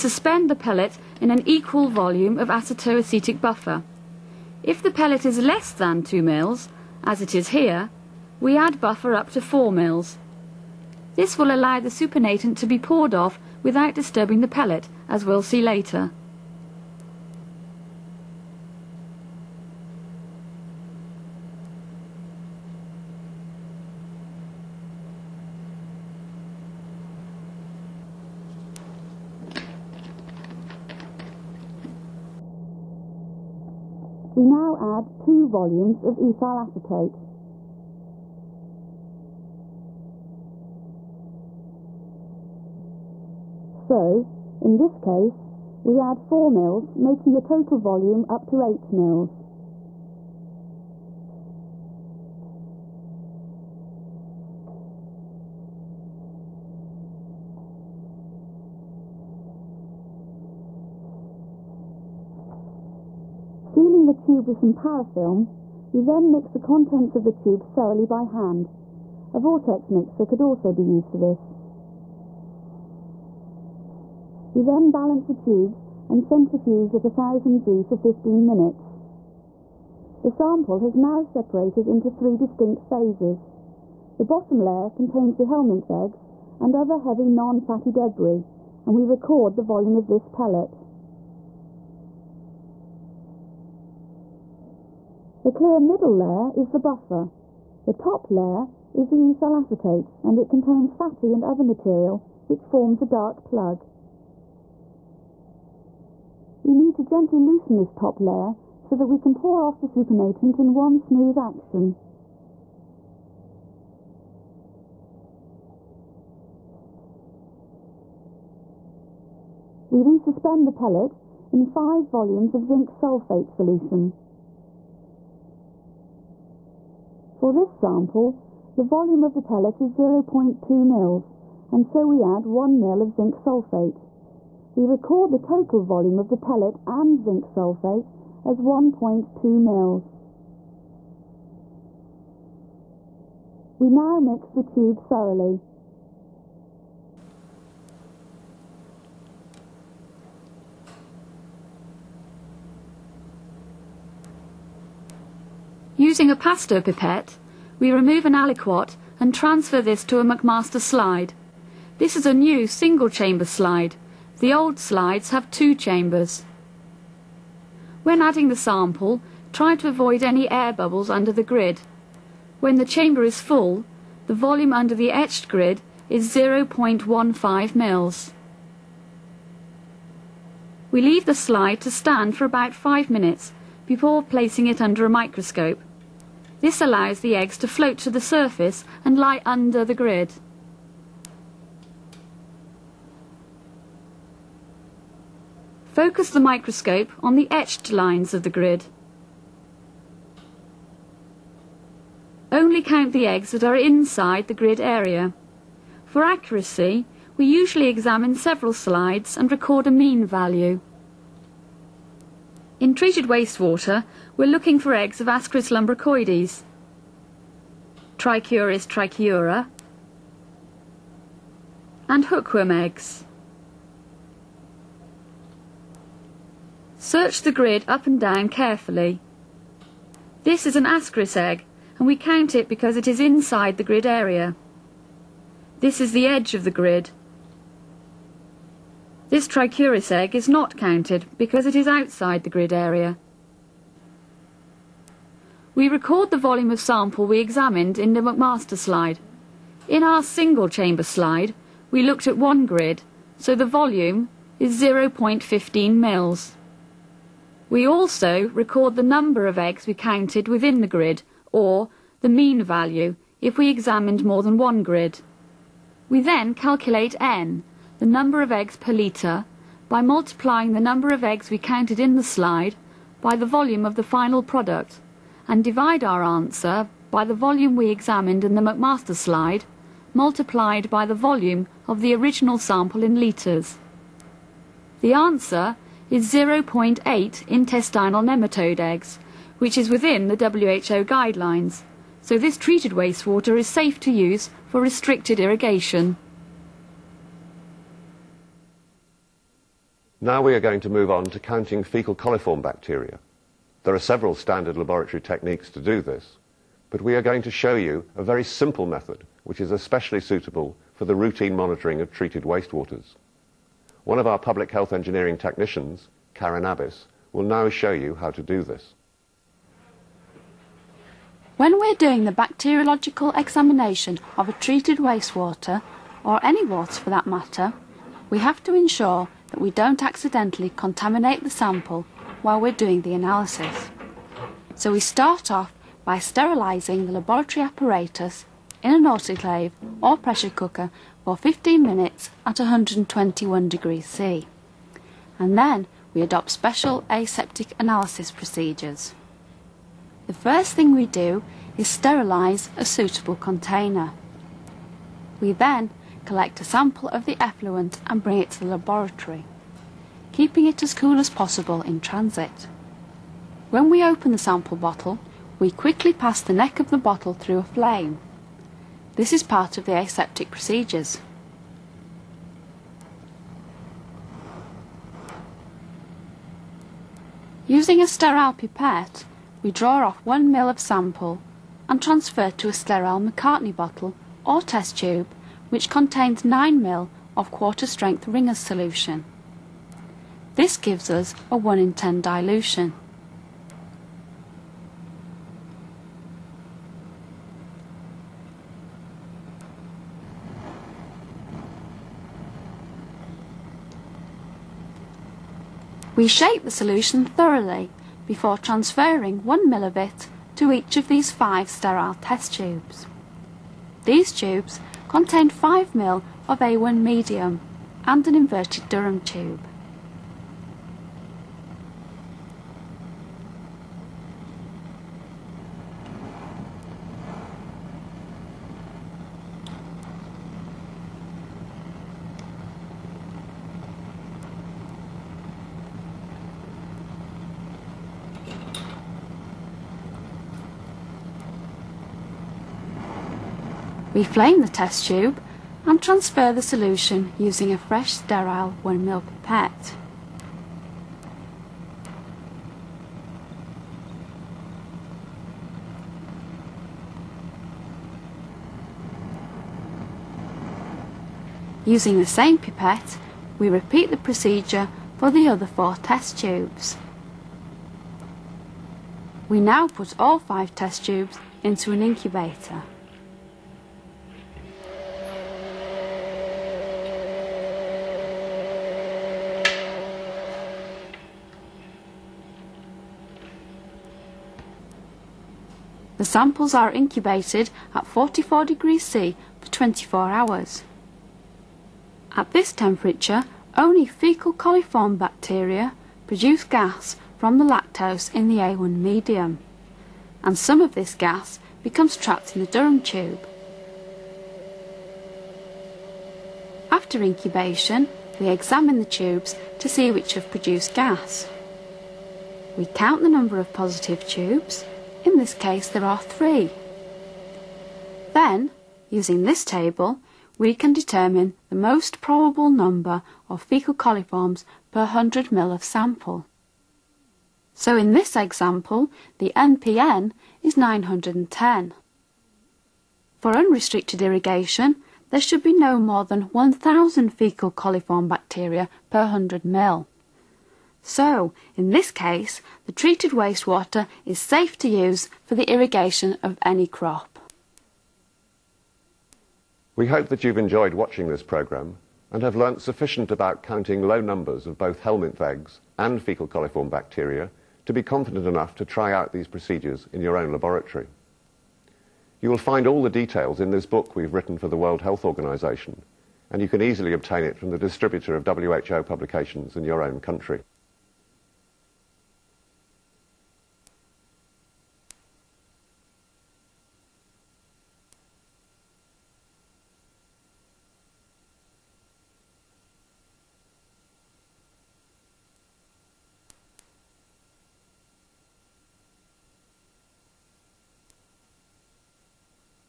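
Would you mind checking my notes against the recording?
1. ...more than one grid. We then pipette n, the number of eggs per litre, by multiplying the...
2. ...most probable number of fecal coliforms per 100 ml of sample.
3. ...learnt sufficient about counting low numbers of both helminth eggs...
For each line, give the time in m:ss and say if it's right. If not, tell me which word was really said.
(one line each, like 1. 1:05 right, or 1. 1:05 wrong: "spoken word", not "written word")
1. 4:24 wrong: "calculate", not "pipette"
2. 8:41 right
3. 9:12 right.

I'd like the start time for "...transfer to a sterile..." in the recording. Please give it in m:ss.
6:22.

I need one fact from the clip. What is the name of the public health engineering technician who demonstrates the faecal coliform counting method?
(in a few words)
Karen Abbas.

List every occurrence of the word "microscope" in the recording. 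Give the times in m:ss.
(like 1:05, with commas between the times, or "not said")
3:05, 3:16.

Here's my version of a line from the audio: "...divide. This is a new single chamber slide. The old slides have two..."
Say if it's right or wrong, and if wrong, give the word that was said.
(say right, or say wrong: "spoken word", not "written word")
wrong: "slide", not "divide".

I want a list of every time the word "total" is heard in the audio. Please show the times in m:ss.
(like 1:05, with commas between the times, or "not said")
0:47, 2:15.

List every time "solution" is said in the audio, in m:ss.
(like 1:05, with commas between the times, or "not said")
2:03, 6:28, 6:46, 7:26.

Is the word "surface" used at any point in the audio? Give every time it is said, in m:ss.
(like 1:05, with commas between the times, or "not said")
3:08.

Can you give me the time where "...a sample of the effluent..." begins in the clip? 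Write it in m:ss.
5:56.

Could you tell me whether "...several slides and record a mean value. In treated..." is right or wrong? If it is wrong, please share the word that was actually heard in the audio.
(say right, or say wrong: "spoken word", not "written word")
right.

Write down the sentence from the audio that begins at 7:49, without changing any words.
We now put all five test tubes into an incubator.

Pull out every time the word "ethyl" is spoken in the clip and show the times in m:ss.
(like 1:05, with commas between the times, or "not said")
0:36, 1:39.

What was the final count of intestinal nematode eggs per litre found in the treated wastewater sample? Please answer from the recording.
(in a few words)
0.8.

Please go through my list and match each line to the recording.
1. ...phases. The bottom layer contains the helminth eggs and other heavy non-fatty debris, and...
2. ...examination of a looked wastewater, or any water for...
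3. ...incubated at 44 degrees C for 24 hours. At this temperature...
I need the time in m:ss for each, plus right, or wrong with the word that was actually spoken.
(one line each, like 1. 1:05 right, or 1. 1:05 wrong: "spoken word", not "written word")
1. 1:22 right
2. 5:23 wrong: "treated", not "looked"
3. 8:06 right.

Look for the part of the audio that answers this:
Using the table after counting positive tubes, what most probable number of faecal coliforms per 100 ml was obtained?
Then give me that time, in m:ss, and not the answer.
8:50.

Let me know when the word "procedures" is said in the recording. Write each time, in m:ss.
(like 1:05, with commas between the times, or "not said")
5:48, 6:10, 7:44, 9:19.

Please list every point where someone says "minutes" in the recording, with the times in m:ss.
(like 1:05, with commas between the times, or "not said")
1:18, 3:03, 5:41.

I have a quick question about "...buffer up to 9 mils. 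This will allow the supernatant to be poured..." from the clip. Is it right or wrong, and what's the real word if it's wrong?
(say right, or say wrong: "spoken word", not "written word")
wrong: "4", not "9".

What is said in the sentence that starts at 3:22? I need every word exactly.
Only count the eggs that are inside the grid area.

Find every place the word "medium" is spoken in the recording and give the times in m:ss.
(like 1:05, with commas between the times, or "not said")
6:56, 8:18.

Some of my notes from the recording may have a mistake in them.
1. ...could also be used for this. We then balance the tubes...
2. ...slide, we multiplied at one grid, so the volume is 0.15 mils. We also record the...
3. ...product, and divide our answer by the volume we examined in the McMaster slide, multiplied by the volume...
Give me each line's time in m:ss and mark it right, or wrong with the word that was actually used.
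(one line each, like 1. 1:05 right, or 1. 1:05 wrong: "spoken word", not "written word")
1. 1:10 right
2. 4:11 wrong: "looked", not "multiplied"
3. 4:34 right.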